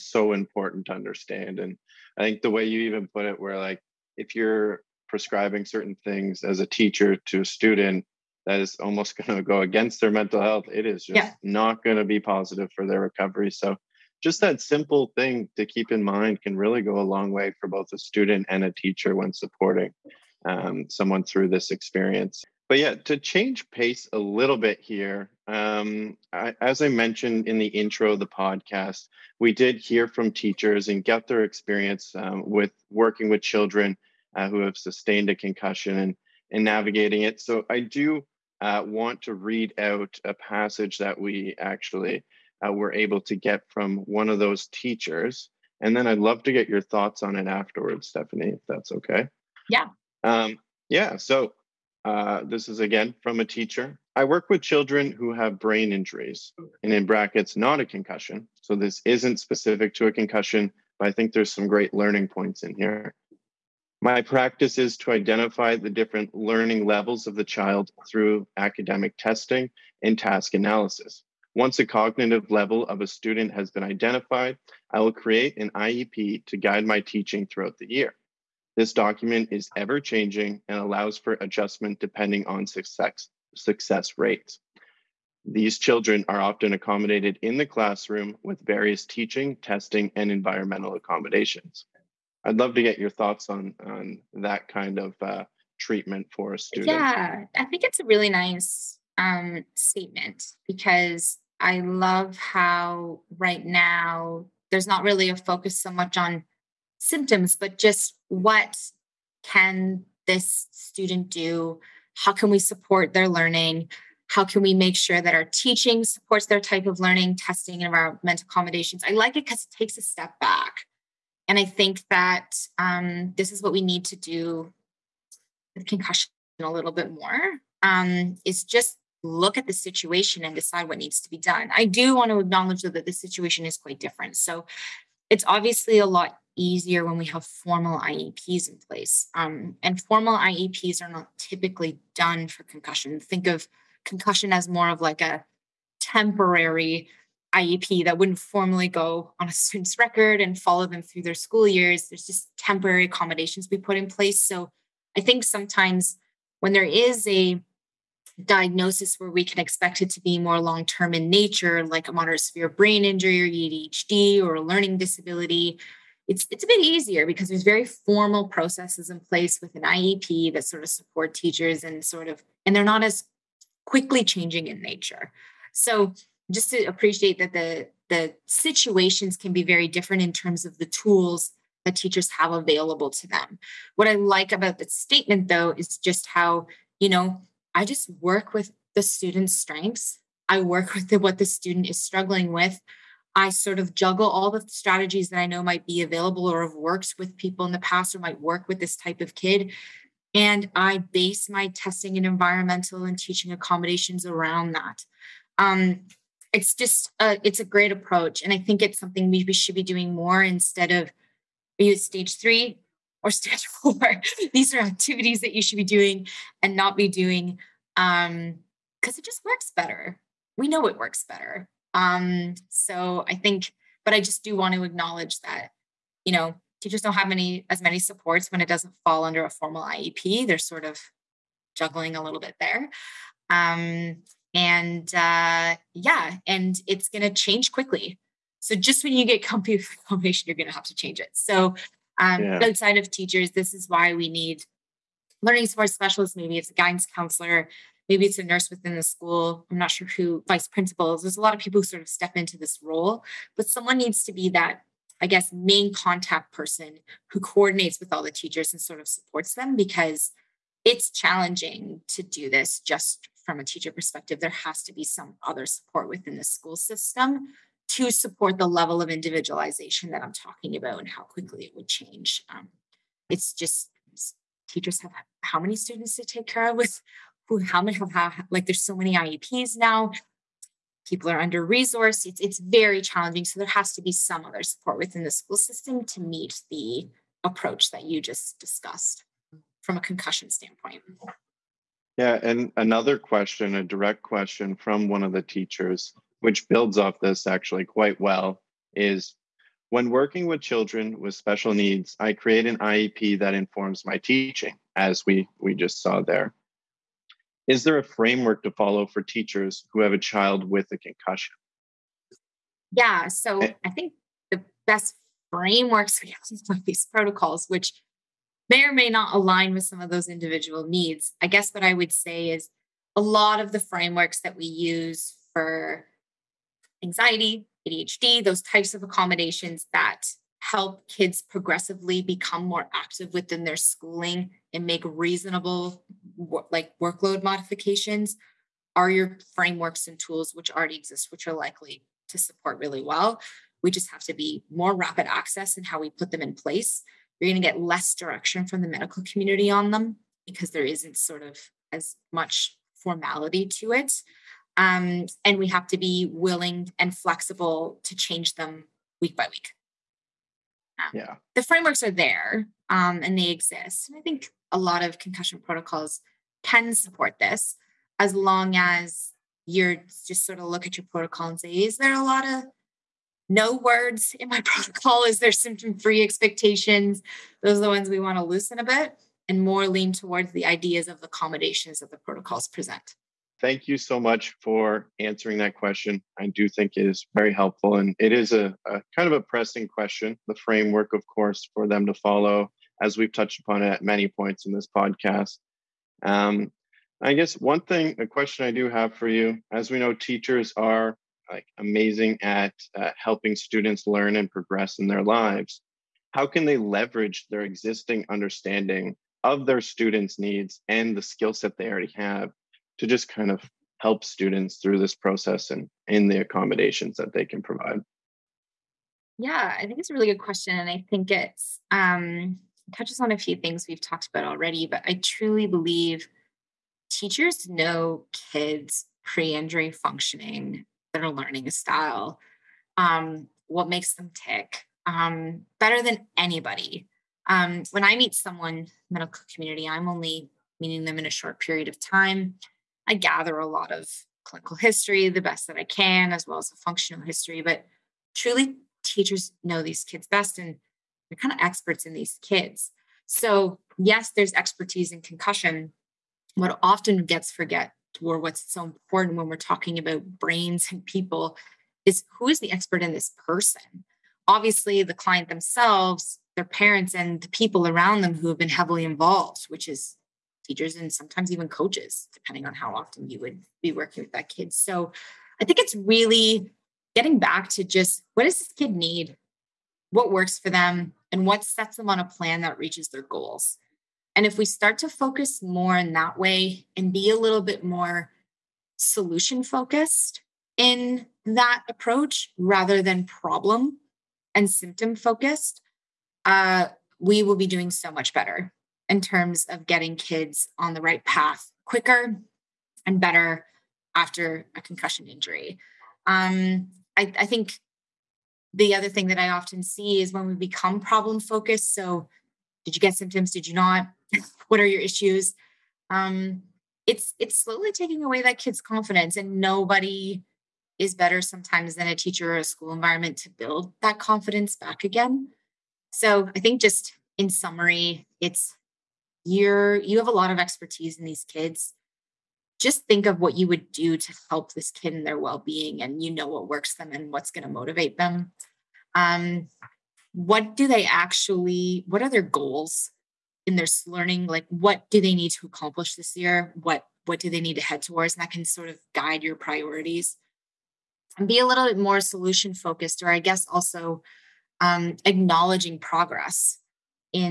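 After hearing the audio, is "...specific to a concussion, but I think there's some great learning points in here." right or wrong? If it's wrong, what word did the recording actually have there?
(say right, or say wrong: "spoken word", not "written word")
right.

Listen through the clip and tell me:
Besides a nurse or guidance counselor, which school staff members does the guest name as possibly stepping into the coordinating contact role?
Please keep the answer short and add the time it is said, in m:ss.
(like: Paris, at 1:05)
Vice principals, at 4:10.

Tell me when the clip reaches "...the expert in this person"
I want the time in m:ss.
7:42.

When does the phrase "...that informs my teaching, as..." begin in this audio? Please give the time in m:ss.
5:03.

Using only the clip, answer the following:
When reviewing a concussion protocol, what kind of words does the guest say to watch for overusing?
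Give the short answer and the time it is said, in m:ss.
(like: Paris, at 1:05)
No words, at 6:13.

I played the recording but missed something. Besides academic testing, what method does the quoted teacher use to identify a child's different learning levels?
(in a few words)
Task analysis.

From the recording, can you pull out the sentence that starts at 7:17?
Um, when I meet someone medical community, I'm only meeting them in a short period of time.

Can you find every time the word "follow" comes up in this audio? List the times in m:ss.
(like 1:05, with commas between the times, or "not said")
2:30, 5:08, 6:32.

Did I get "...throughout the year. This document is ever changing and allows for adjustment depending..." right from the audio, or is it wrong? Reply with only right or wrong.
right.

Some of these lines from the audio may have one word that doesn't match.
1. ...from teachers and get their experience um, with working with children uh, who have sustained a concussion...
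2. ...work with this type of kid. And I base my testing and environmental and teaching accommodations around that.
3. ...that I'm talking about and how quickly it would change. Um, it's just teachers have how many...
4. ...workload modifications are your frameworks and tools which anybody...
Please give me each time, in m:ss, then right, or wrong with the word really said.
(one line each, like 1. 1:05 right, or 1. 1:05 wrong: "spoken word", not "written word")
1. 0:30 right
2. 3:18 right
3. 4:30 right
4. 5:37 wrong: "already", not "anybody".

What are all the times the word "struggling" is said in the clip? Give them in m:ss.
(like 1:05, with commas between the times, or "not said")
3:12.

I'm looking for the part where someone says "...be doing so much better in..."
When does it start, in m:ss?
8:17.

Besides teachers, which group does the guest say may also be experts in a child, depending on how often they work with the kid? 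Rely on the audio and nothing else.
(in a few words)
Coaches.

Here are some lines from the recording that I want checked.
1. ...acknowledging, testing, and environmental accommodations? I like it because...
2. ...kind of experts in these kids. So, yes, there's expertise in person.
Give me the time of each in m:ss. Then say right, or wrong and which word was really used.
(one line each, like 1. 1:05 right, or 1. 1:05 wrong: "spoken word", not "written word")
1. 1:56 wrong: "learning", not "acknowledging"
2. 7:31 wrong: "concussion", not "person".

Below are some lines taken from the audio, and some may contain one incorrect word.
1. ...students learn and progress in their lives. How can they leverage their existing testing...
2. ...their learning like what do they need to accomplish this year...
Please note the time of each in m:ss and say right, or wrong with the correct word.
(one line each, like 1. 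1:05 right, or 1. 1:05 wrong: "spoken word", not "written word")
1. 6:43 wrong: "understanding", not "testing"
2. 9:03 right.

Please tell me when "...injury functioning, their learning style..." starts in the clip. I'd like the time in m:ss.
7:09.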